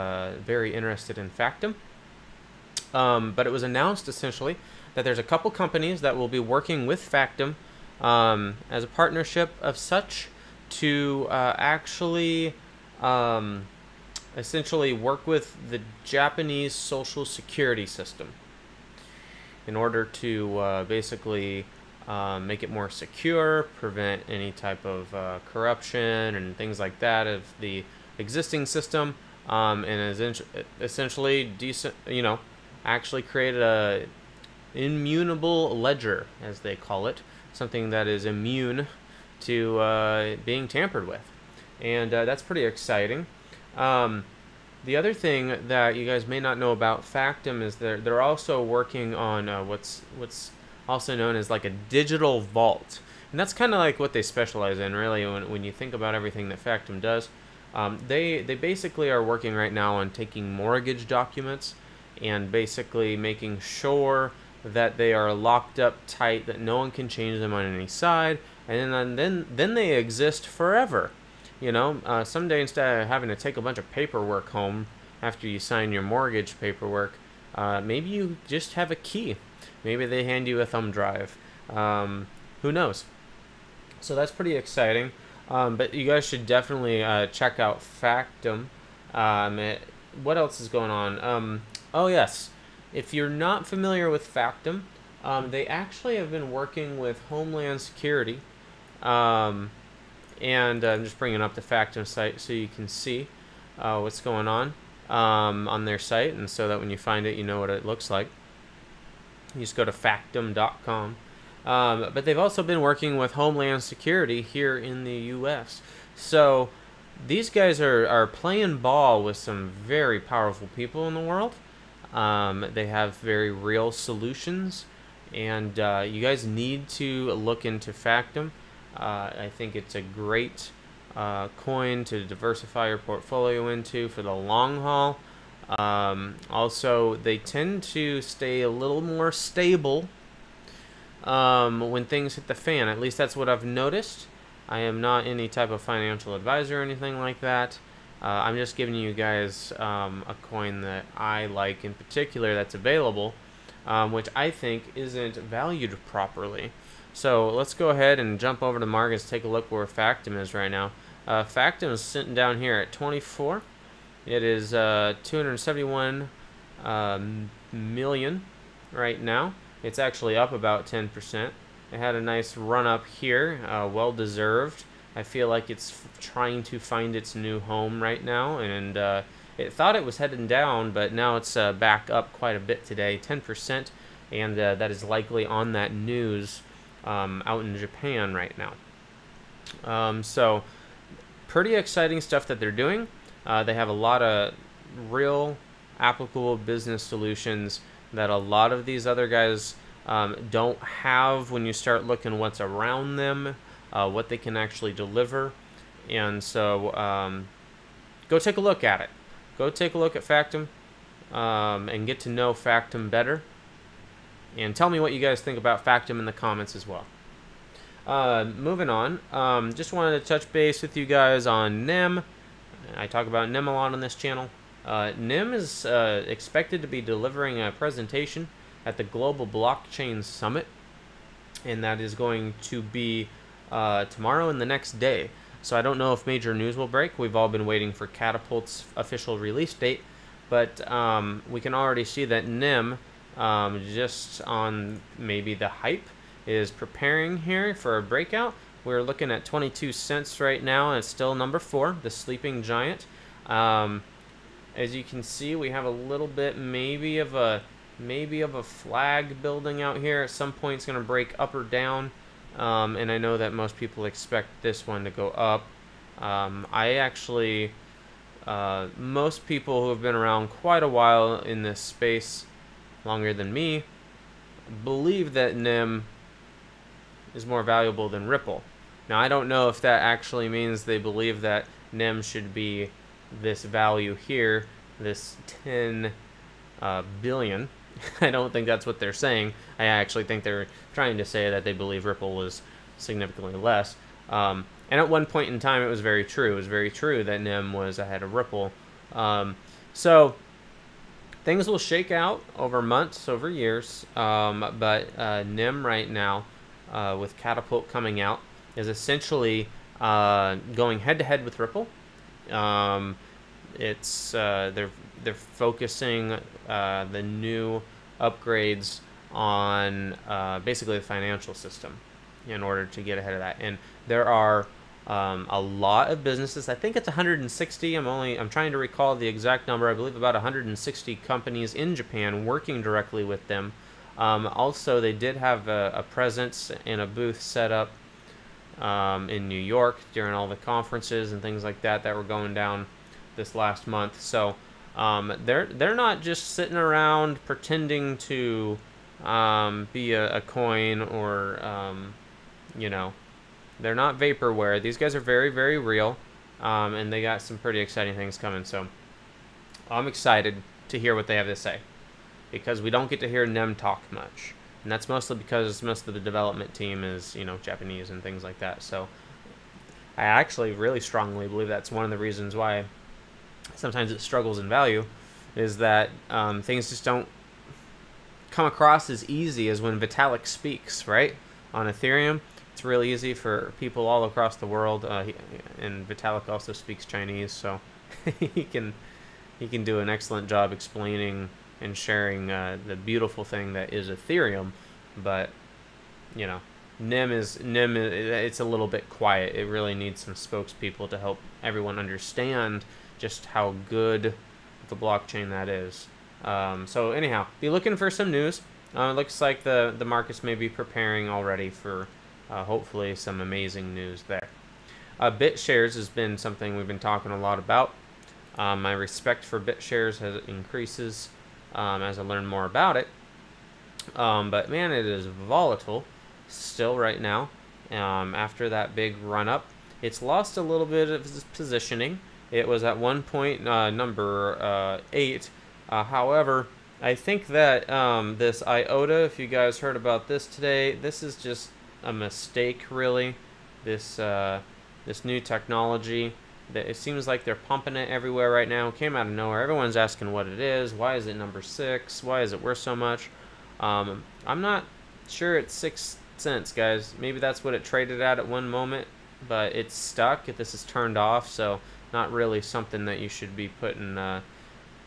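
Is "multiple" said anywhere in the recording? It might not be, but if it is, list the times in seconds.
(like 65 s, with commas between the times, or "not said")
not said.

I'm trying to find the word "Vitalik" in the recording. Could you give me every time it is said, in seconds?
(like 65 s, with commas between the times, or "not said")
379 s, 386 s.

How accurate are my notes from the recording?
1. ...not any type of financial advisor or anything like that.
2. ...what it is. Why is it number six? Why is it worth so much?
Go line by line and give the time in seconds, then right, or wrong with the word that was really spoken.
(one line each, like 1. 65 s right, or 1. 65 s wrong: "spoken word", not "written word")
1. 144 s right
2. 450 s right.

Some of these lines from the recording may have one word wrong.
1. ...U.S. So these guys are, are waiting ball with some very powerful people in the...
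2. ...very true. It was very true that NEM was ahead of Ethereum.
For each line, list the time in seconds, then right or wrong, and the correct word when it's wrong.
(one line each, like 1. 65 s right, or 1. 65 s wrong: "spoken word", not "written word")
1. 115 s wrong: "playing", not "waiting"
2. 295 s wrong: "Ripple", not "Ethereum".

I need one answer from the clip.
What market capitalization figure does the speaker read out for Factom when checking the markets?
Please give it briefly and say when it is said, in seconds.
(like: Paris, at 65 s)
271 million, at 165 s.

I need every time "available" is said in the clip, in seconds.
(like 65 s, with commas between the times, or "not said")
152 s.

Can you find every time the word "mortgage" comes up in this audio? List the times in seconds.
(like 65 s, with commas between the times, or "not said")
60 s, 76 s.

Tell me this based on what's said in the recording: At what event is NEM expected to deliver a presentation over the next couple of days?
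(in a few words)
Global Blockchain Summit.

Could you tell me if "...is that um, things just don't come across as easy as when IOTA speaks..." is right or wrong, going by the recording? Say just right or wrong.
wrong.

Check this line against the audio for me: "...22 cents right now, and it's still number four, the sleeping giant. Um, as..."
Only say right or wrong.
right.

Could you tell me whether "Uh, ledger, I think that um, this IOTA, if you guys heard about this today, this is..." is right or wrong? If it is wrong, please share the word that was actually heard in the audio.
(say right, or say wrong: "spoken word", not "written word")
wrong: "however", not "ledger".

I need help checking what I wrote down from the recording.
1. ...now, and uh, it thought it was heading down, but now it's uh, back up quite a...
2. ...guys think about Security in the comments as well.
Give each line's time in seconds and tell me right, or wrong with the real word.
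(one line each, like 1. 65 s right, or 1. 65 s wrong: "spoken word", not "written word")
1. 178 s right
2. 215 s wrong: "Factom", not "Security".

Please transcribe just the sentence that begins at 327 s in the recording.
I'm only I'm trying to recall the exact number.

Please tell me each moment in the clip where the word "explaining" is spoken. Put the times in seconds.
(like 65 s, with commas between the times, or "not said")
390 s.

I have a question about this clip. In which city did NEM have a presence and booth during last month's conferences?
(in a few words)
New York.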